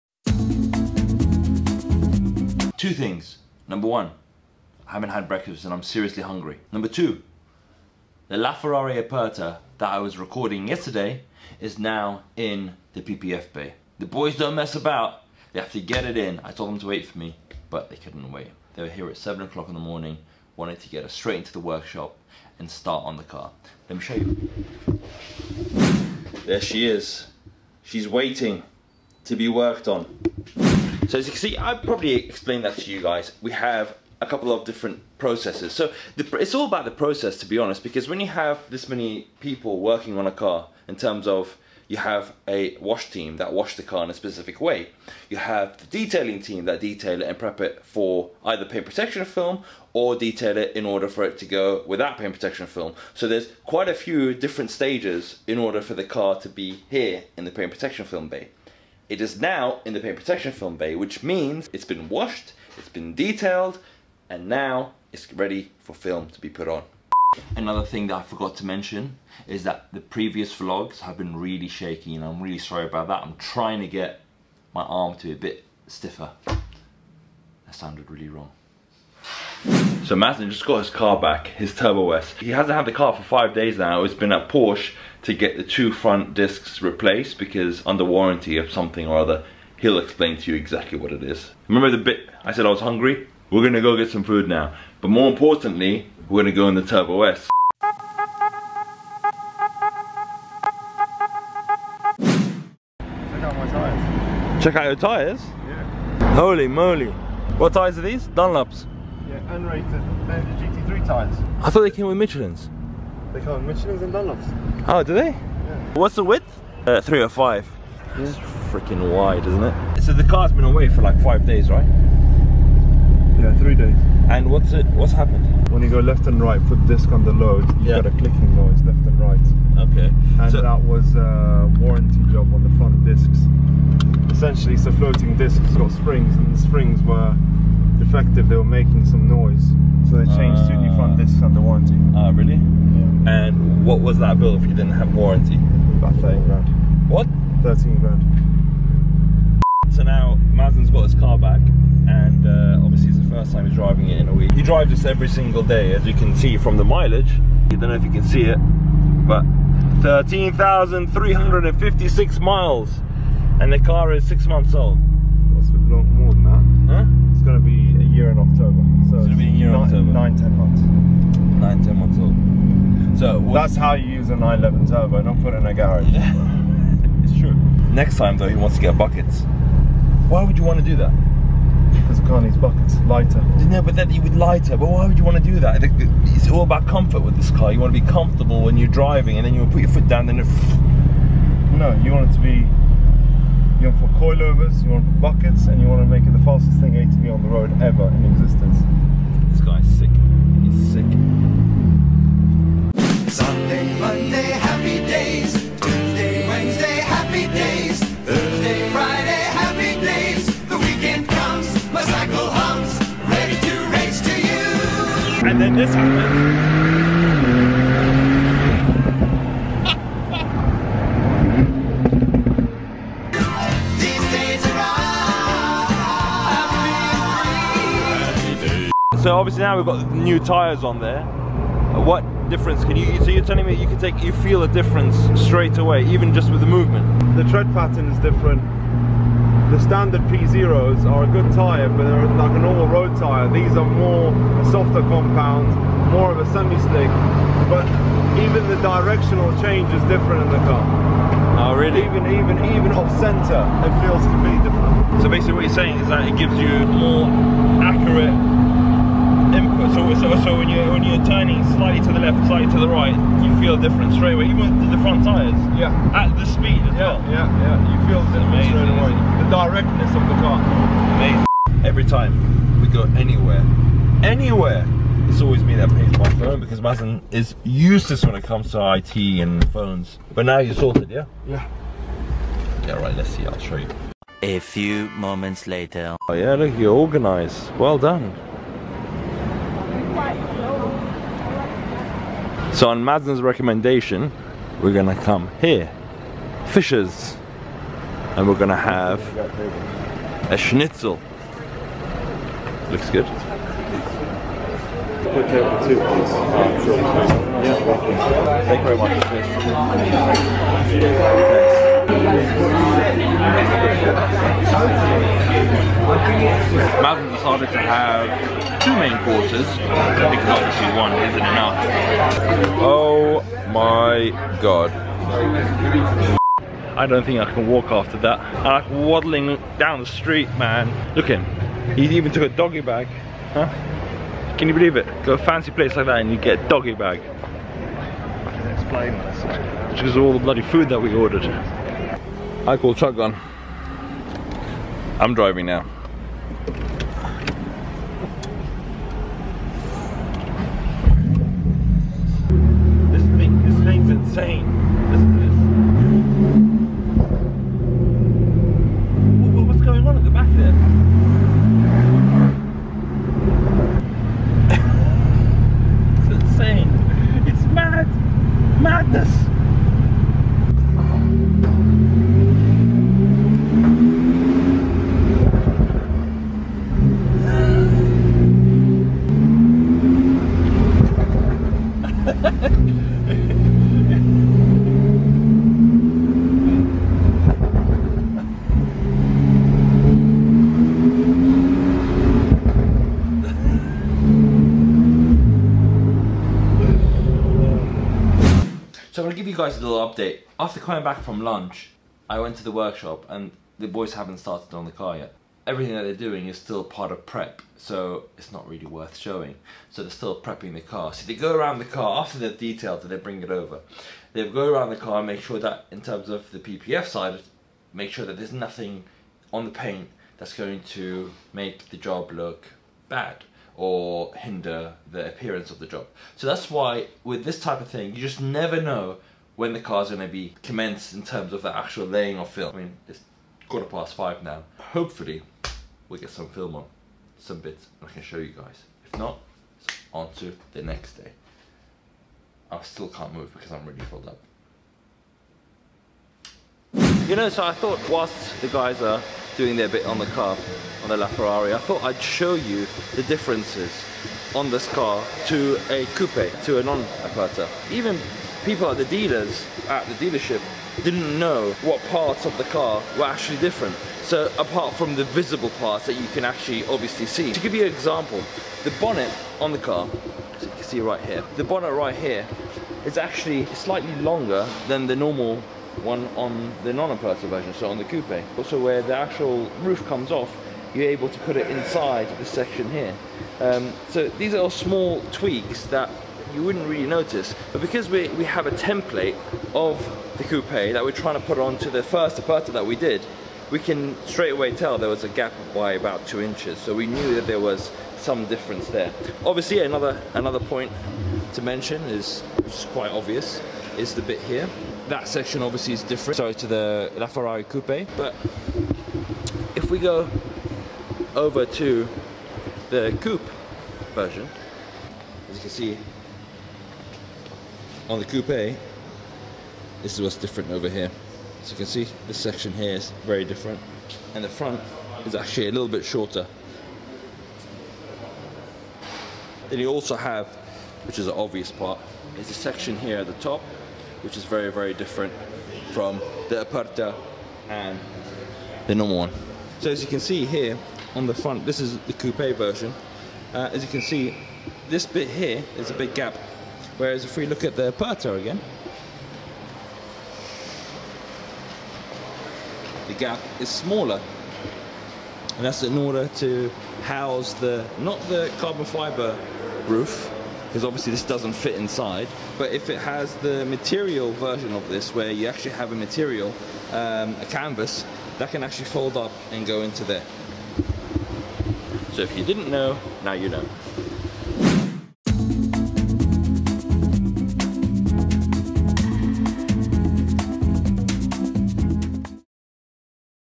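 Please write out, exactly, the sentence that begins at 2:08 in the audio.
got a clicking noise left and right.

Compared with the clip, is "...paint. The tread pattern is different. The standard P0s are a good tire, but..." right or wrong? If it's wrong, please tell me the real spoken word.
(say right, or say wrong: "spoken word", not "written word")
wrong: "movement", not "paint".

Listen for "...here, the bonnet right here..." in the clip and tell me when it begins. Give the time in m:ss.
7:51.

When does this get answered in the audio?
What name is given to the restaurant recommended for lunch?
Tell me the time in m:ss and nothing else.
4:56.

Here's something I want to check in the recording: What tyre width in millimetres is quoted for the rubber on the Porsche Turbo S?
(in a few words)
305.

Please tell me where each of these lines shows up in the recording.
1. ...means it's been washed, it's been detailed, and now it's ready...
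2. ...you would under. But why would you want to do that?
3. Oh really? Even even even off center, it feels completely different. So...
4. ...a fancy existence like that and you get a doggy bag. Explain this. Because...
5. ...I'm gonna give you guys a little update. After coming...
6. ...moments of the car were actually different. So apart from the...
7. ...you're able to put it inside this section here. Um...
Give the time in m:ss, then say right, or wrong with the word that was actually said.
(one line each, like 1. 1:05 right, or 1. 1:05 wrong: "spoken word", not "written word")
1. 1:01 right
2. 3:04 wrong: "lighter", not "under"
3. 4:11 right
4. 5:35 wrong: "place", not "existence"
5. 6:39 right
6. 7:42 wrong: "parts", not "moments"
7. 8:00 right.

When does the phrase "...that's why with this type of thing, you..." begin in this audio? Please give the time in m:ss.
7:06.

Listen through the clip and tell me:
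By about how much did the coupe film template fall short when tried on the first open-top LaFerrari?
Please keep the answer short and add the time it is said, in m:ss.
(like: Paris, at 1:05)
2 inches, at 8:16.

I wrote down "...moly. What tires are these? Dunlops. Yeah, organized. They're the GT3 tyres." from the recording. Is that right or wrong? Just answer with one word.
wrong.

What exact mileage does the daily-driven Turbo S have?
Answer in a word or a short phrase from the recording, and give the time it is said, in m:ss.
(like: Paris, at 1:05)
13,356 miles, at 2:40.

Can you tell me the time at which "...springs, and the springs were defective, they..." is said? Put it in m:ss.
2:15.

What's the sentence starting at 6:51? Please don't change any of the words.
So they go around the car, after they've detailed it, they bring it over.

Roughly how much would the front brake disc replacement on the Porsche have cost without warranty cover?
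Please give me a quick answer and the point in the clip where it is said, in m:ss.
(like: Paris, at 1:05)
13 grand, at 2:26.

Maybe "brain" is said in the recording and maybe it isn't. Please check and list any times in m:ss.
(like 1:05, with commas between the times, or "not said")
not said.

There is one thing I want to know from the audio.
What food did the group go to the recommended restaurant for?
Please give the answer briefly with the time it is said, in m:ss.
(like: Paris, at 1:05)
schnitzel, at 5:00.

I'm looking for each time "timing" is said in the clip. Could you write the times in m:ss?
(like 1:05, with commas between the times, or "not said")
not said.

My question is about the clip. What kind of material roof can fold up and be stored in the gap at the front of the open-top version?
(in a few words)
canvas.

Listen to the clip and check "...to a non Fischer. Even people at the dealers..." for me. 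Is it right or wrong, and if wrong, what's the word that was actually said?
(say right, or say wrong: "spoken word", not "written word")
wrong: "Aperta", not "Fischer".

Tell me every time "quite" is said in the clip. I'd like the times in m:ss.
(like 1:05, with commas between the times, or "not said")
0:53, 8:22.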